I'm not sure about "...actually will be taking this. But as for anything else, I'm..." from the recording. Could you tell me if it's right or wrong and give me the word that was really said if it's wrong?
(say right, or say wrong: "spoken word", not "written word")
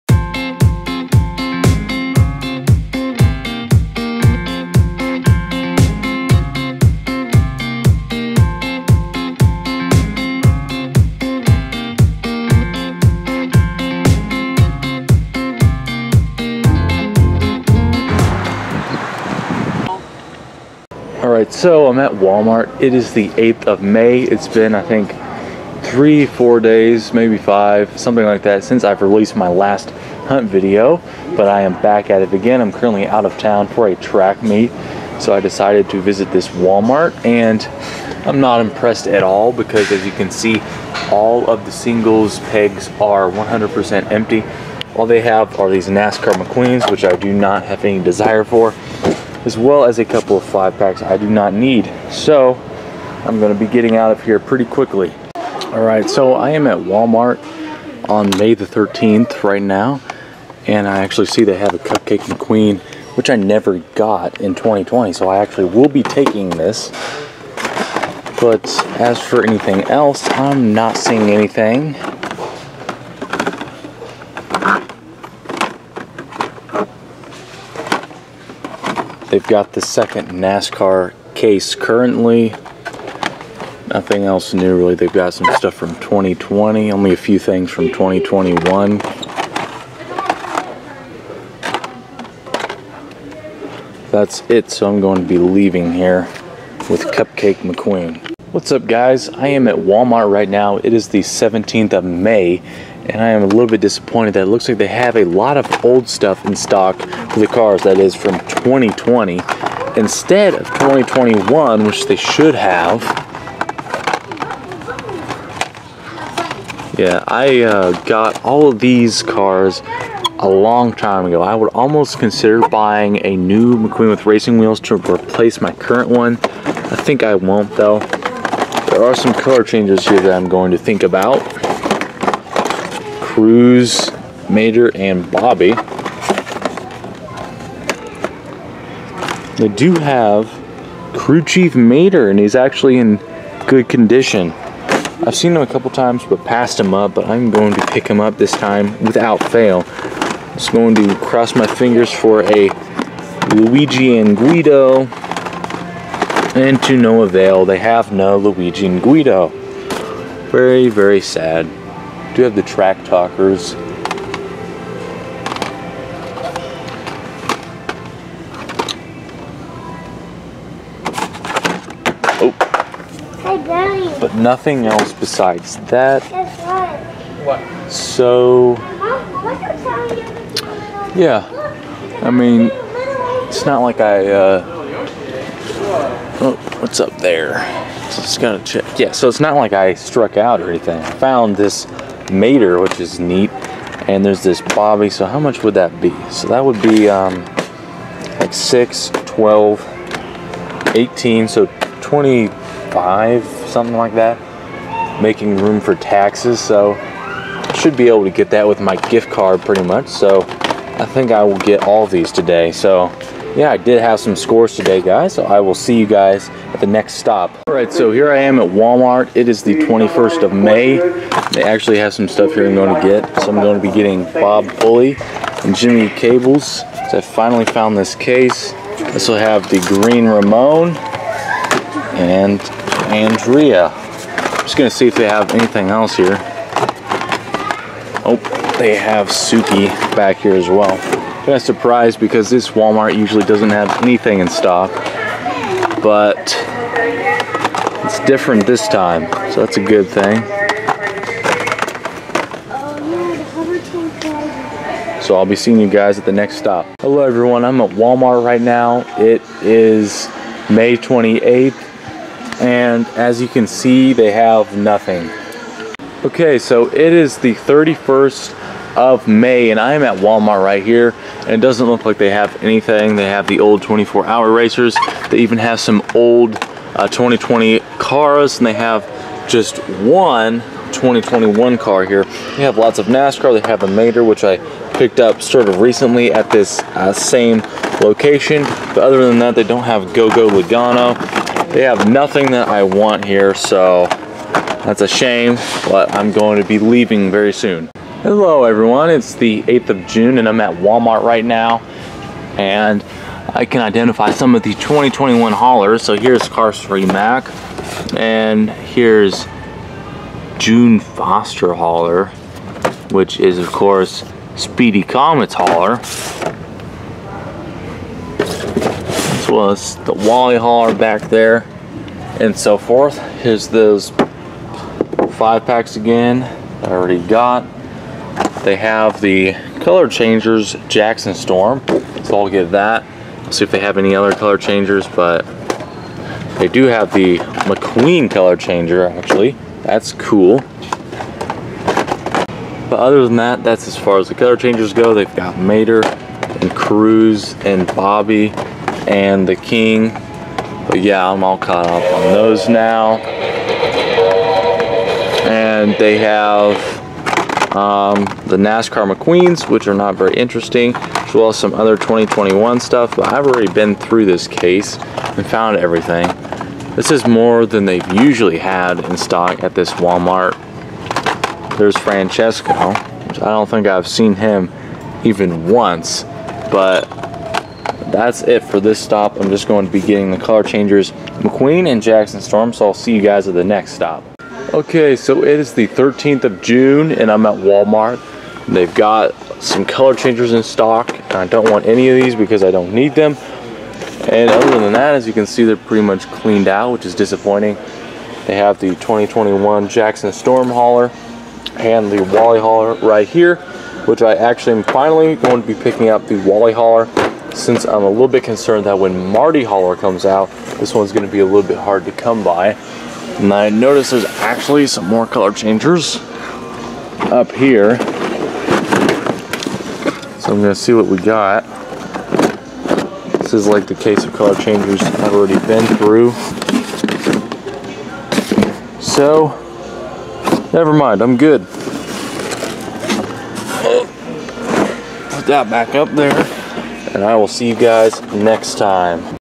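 right.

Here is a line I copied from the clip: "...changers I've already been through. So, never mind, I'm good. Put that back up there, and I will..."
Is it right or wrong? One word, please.
right.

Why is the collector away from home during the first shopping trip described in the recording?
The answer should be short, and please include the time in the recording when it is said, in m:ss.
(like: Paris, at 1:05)
A track meet, at 0:33.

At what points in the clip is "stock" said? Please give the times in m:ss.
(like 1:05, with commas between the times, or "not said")
1:46, 4:04, 6:09, 6:30.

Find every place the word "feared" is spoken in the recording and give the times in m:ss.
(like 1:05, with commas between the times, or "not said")
not said.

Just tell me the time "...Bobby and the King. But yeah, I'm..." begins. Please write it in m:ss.
5:47.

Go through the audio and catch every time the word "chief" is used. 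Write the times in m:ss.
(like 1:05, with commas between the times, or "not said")
2:21.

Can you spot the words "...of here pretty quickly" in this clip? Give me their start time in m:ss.
0:54.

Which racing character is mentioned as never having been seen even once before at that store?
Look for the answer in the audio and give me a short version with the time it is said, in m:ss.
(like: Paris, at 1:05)
Francesco, at 6:11.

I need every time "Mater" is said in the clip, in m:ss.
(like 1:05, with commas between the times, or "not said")
2:14, 2:21, 3:12, 4:43, 5:45.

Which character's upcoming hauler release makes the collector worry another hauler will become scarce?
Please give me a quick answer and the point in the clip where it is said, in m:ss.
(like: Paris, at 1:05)
Marty, at 6:49.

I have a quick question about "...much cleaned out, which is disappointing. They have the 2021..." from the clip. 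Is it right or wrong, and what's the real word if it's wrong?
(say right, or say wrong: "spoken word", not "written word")
right.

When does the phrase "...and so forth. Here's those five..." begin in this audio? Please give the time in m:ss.
5:22.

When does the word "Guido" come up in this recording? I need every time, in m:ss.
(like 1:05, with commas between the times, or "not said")
2:34, 2:39.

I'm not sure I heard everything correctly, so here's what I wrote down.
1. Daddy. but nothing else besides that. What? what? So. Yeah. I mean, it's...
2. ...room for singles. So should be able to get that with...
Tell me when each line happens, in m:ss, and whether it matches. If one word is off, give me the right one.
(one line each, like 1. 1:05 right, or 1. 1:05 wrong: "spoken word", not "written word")
1. 2:53 right
2. 3:25 wrong: "taxes", not "singles".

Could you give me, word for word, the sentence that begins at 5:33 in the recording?
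I'll see if they have any other color changers, but they do have the McQueen color changer actually.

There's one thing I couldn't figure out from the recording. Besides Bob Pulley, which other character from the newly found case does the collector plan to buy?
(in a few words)
Jimmy Cables.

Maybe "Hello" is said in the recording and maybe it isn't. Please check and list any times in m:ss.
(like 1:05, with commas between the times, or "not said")
4:17, 4:58.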